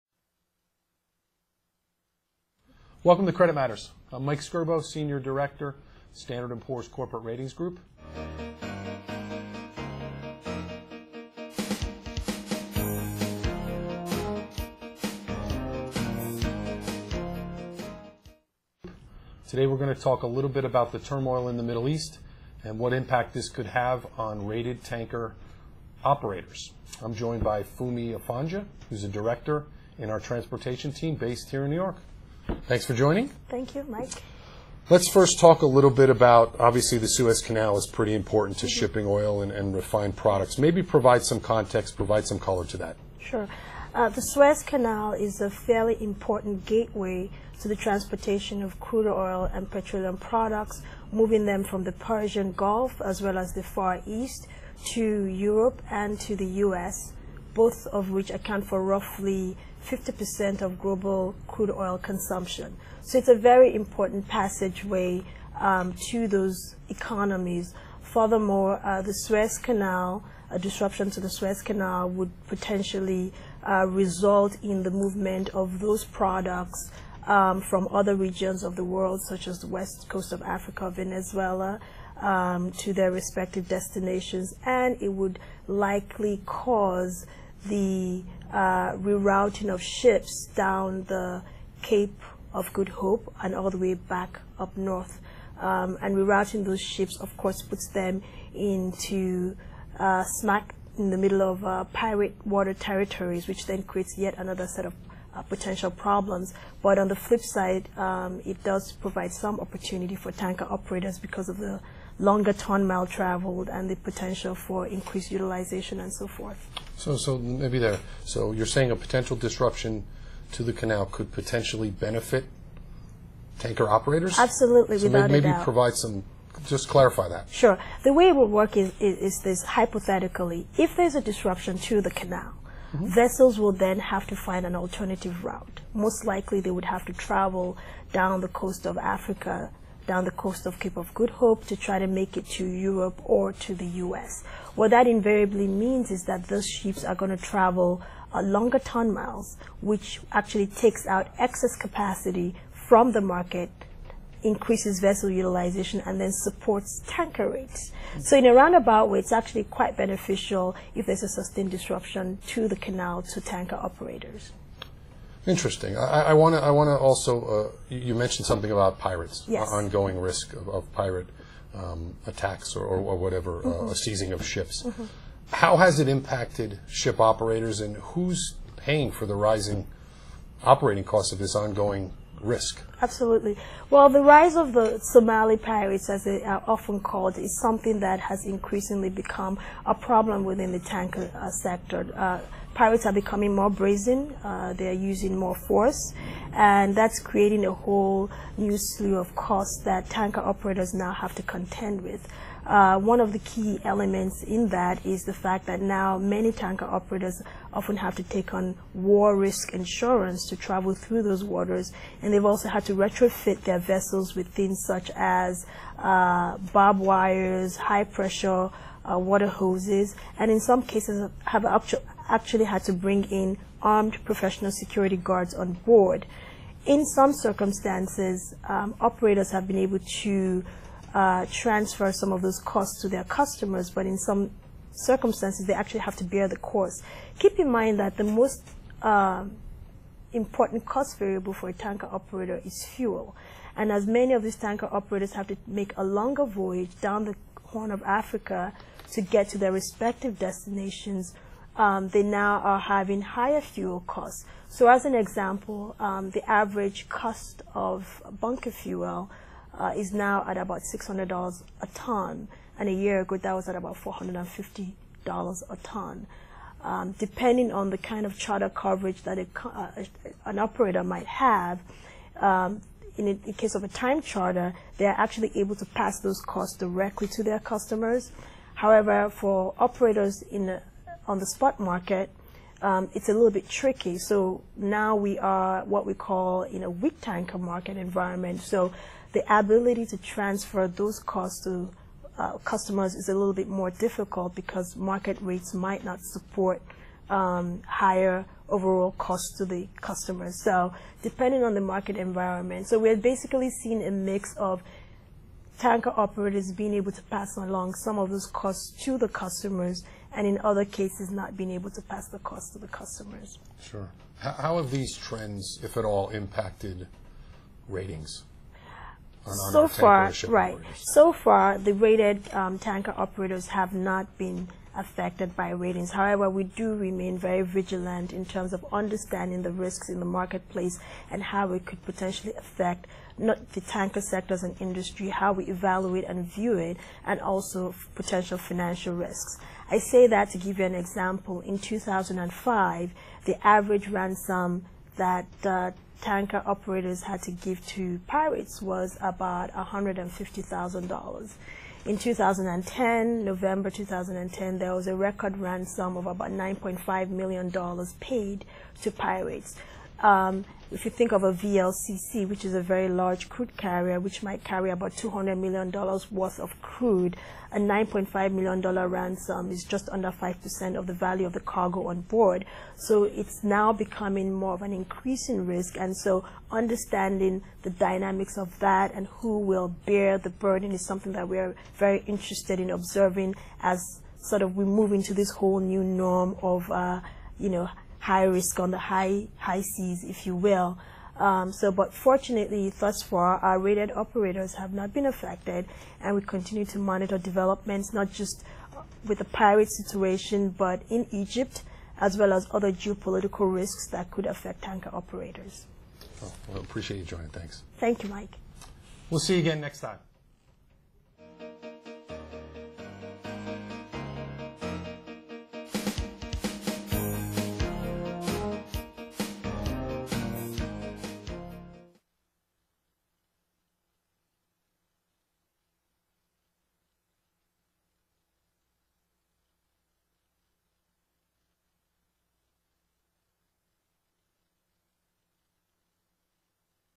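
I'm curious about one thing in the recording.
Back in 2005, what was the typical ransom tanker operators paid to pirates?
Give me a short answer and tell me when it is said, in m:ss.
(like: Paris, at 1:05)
$150,000, at 5:49.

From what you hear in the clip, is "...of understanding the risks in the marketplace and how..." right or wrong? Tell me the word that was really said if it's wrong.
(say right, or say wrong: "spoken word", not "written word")
right.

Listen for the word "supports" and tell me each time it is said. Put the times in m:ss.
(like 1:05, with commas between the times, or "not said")
2:36, 4:56.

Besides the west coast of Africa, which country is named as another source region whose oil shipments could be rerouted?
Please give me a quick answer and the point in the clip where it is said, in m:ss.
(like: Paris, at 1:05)
Venezuela, at 1:20.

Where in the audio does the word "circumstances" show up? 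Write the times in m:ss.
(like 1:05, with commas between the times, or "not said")
3:47, 3:54.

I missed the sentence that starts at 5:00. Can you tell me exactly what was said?
So depending on the market environment.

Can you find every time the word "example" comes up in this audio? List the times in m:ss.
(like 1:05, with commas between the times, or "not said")
4:15, 5:40.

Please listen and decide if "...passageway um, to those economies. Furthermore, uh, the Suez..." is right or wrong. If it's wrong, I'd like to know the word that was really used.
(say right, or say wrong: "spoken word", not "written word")
right.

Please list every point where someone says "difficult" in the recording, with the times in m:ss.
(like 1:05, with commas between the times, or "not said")
4:53.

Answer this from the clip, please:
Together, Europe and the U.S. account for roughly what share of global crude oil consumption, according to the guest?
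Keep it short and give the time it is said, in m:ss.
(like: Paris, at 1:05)
50%, at 0:59.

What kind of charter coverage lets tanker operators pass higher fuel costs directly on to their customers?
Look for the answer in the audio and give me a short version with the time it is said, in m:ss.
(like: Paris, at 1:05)
time charter, at 4:33.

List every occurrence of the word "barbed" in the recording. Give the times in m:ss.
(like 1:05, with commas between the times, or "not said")
3:36.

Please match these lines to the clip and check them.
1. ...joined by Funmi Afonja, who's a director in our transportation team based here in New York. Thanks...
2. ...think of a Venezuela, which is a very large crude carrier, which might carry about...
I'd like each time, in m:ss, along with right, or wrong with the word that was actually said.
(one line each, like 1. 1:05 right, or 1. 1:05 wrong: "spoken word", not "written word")
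1. 0:27 right
2. 6:01 wrong: "VLCC", not "Venezuela".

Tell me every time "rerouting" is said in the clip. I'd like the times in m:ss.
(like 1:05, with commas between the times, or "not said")
1:28, 1:36.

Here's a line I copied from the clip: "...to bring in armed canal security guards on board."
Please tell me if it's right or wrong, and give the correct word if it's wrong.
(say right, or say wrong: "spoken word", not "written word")
wrong: "professional", not "canal".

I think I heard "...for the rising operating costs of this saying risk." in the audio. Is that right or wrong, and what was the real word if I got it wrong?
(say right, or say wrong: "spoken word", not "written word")
wrong: "ongoing", not "saying".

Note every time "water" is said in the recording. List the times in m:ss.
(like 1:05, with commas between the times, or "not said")
1:42, 3:31, 3:39.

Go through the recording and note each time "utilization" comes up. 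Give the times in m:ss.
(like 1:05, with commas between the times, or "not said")
1:55, 2:35.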